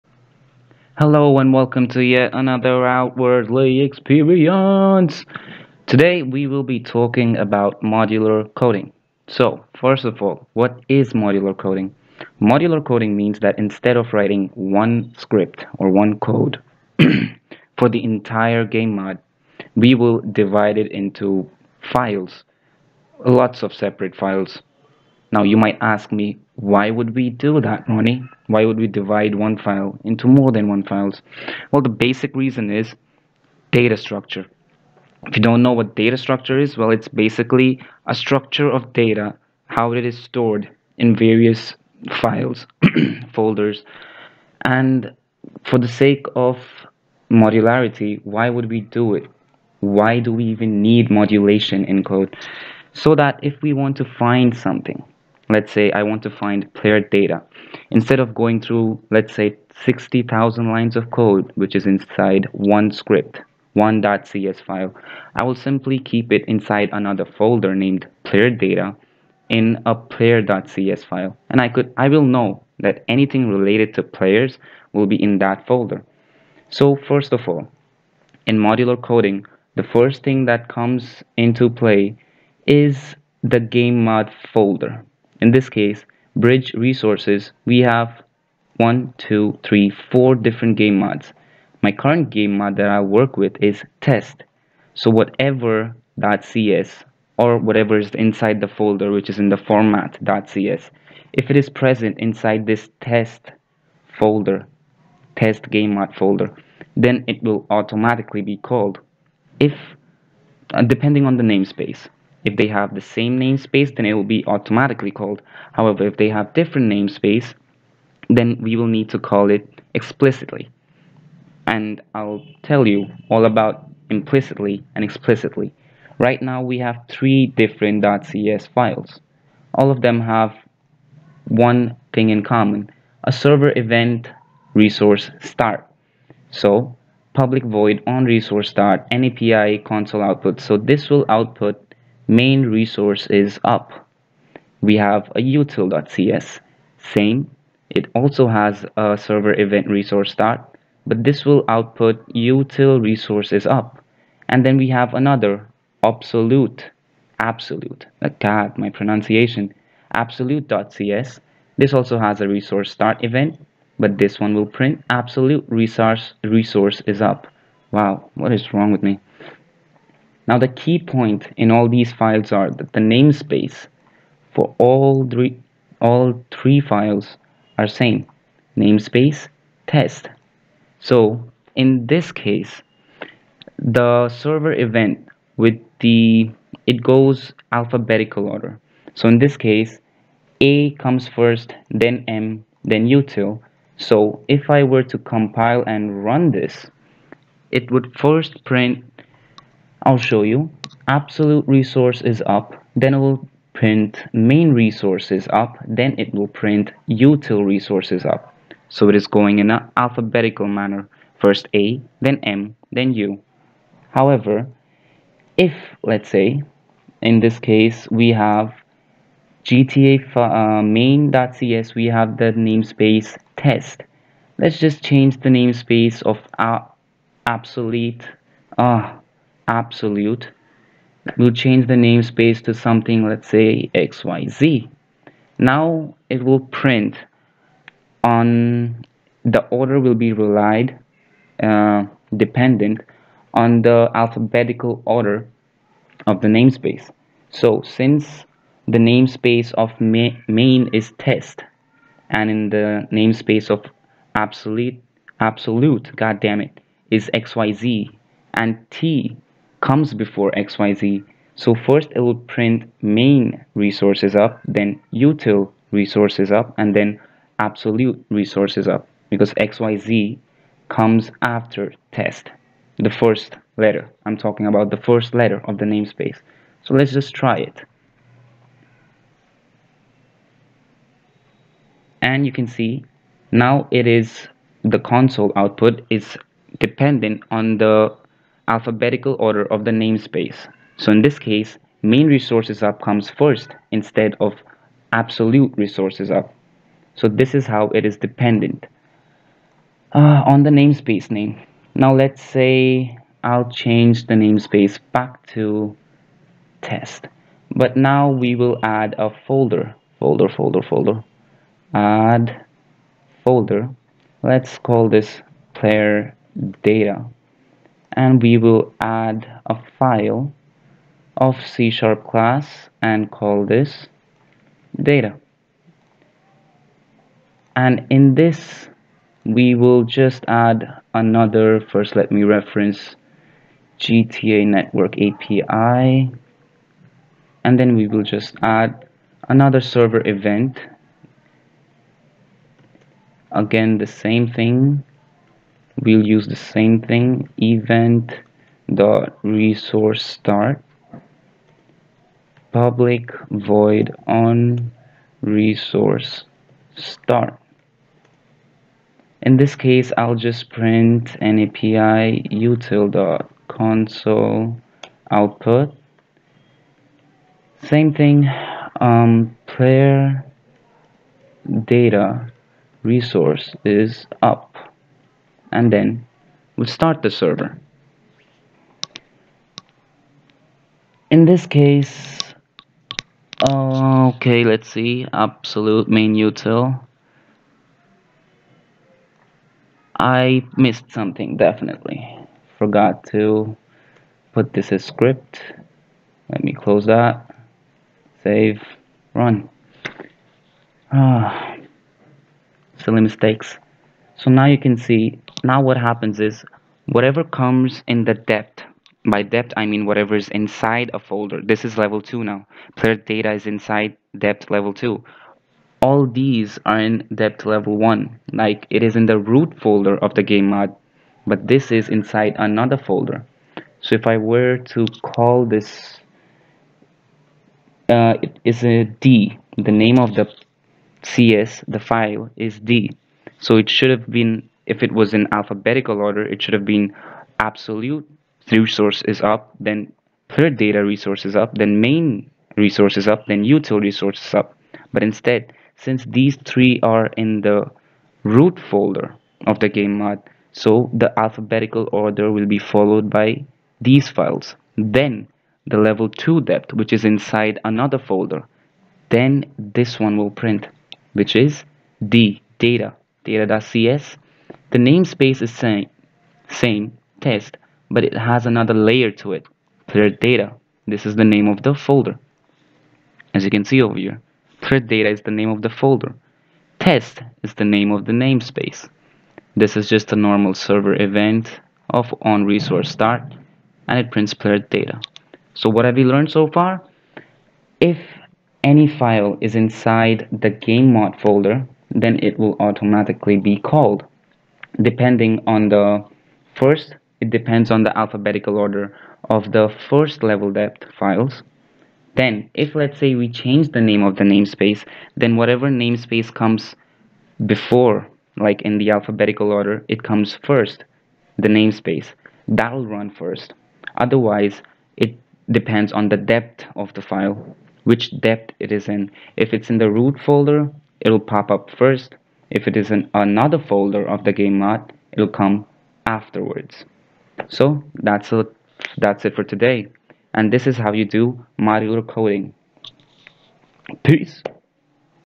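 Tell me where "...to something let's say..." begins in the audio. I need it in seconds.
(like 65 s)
232 s.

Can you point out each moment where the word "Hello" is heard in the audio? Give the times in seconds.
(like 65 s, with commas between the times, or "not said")
0 s.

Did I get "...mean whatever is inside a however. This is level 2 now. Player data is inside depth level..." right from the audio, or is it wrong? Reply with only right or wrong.
wrong.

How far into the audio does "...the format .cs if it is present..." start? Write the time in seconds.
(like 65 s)
99 s.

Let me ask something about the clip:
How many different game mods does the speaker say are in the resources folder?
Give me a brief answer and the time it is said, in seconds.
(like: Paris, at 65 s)
4, at 90 s.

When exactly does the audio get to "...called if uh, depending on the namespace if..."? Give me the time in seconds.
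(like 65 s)
108 s.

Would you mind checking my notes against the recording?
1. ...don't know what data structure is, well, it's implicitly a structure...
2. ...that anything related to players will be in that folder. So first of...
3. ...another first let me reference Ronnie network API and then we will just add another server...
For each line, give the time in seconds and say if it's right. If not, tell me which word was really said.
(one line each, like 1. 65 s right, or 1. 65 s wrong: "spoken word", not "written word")
1. 35 s wrong: "basically", not "implicitly"
2. 72 s right
3. 331 s wrong: "GTA", not "Ronnie".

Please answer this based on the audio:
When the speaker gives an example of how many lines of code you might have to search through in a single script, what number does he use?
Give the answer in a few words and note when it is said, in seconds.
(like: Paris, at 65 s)
60,000, at 59 s.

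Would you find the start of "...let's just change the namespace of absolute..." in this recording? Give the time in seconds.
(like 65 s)
224 s.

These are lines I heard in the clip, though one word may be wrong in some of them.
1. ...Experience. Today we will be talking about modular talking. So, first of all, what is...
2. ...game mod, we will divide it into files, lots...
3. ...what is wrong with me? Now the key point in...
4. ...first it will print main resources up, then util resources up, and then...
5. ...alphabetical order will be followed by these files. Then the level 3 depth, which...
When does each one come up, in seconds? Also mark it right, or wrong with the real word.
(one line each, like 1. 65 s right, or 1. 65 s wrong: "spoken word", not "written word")
1. 3 s wrong: "coding", not "talking"
2. 18 s right
3. 168 s right
4. 261 s right
5. 451 s wrong: "2", not "3".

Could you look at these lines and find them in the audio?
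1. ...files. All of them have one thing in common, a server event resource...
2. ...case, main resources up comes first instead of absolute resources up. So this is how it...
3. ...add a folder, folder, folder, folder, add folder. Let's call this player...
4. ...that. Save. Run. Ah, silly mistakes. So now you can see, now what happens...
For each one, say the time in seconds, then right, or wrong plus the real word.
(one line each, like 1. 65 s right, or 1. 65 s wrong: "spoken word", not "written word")
1. 128 s right
2. 291 s right
3. 308 s right
4. 397 s right.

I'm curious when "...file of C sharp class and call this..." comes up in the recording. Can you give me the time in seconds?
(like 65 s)
319 s.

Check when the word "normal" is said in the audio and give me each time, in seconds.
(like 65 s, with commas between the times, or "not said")
480 s.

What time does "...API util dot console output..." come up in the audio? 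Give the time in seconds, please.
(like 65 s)
361 s.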